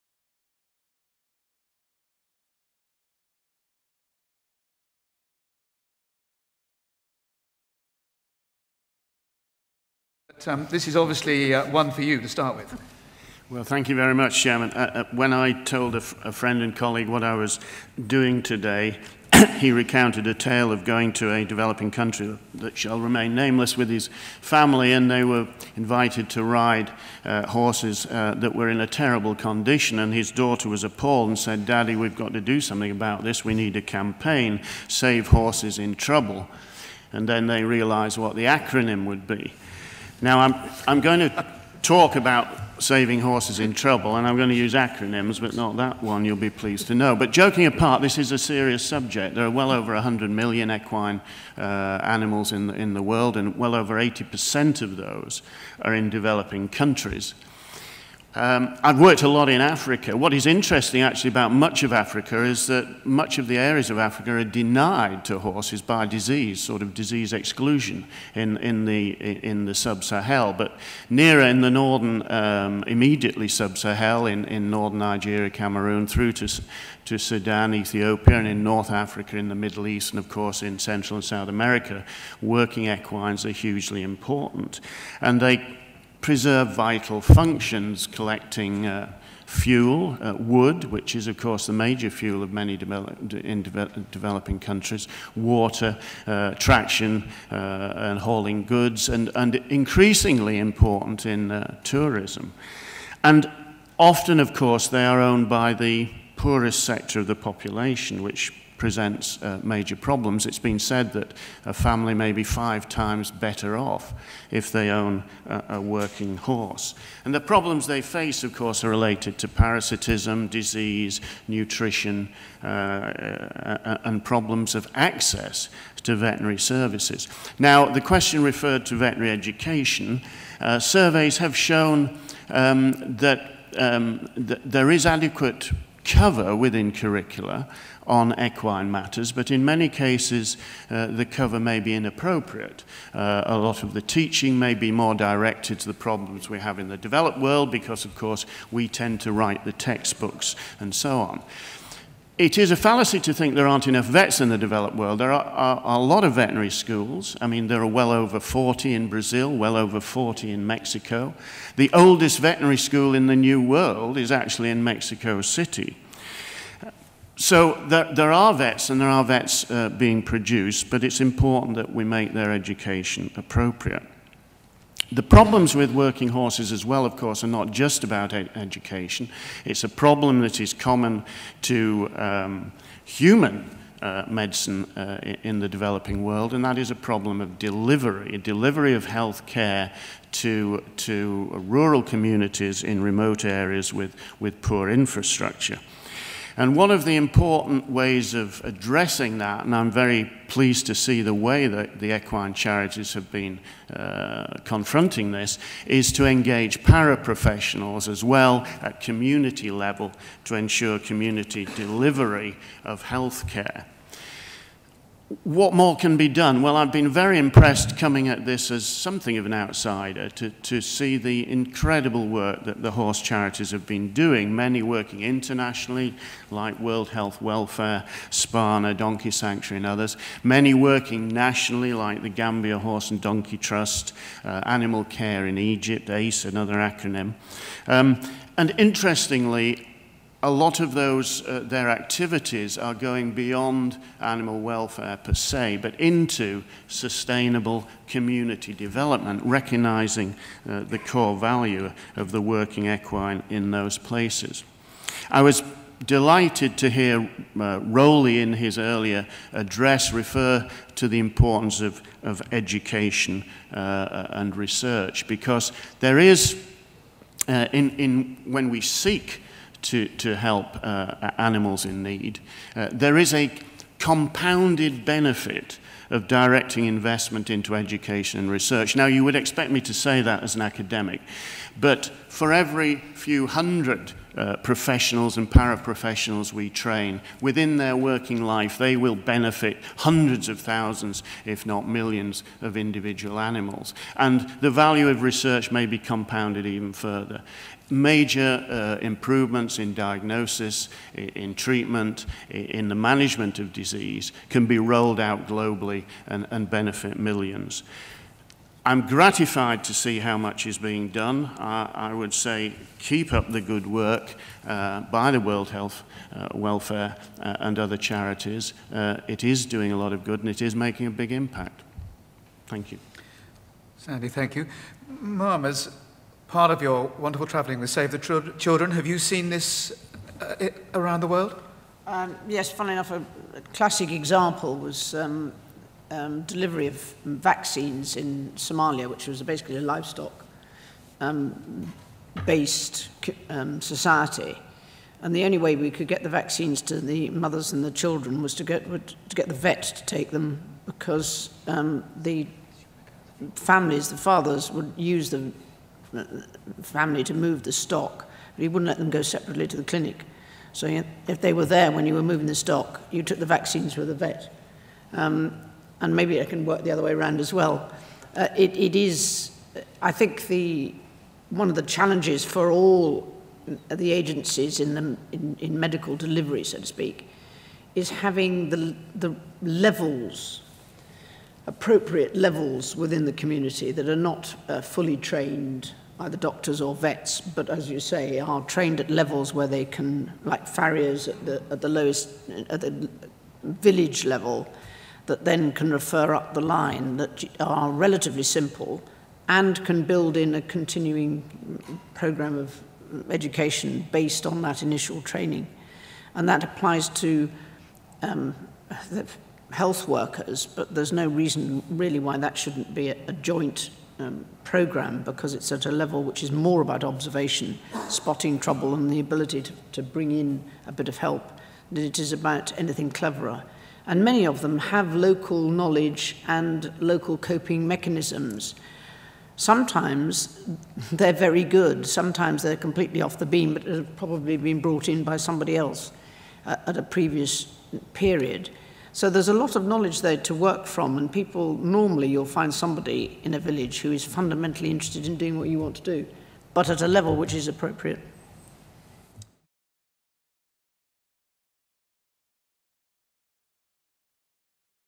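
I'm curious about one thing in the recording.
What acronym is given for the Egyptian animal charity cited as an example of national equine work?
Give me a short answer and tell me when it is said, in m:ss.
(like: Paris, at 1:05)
ACE, at 3:56.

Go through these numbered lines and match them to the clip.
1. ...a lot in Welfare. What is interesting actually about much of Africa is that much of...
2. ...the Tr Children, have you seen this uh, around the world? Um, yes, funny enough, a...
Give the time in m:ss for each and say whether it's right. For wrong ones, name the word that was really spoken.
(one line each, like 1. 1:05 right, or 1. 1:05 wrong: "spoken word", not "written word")
1. 0:59 wrong: "Africa", not "Welfare"
2. 5:28 right.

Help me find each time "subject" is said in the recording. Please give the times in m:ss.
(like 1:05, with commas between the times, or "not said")
0:48.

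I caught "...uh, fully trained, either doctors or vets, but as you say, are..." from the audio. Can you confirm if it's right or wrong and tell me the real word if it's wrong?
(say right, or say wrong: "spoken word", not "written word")
right.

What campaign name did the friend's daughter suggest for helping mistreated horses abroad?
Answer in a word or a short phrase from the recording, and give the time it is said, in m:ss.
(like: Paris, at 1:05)
Save Horses in Trouble, at 0:34.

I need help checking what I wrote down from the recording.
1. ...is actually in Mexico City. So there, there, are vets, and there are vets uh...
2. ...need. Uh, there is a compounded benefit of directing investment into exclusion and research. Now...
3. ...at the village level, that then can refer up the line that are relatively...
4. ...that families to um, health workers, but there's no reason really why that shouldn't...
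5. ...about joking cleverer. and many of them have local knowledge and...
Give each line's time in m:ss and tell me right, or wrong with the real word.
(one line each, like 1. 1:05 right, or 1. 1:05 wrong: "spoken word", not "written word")
1. 2:44 right
2. 4:32 wrong: "education", not "exclusion"
3. 6:32 right
4. 6:46 wrong: "applies", not "families"
5. 7:02 wrong: "anything", not "joking".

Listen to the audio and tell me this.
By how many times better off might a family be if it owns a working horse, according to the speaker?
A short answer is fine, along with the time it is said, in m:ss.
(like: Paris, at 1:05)
5, at 1:52.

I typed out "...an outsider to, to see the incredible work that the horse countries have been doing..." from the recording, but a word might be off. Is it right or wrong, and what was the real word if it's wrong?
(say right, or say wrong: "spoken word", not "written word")
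wrong: "charities", not "countries".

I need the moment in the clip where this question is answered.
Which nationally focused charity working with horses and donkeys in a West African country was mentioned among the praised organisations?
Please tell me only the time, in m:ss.
3:52.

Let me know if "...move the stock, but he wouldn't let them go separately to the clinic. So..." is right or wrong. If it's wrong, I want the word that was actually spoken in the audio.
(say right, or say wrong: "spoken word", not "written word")
right.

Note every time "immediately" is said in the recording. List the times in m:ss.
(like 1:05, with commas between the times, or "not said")
1:12.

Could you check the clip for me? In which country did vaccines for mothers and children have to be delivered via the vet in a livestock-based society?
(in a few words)
Somalia.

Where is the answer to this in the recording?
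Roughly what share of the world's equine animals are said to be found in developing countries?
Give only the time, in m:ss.
0:53.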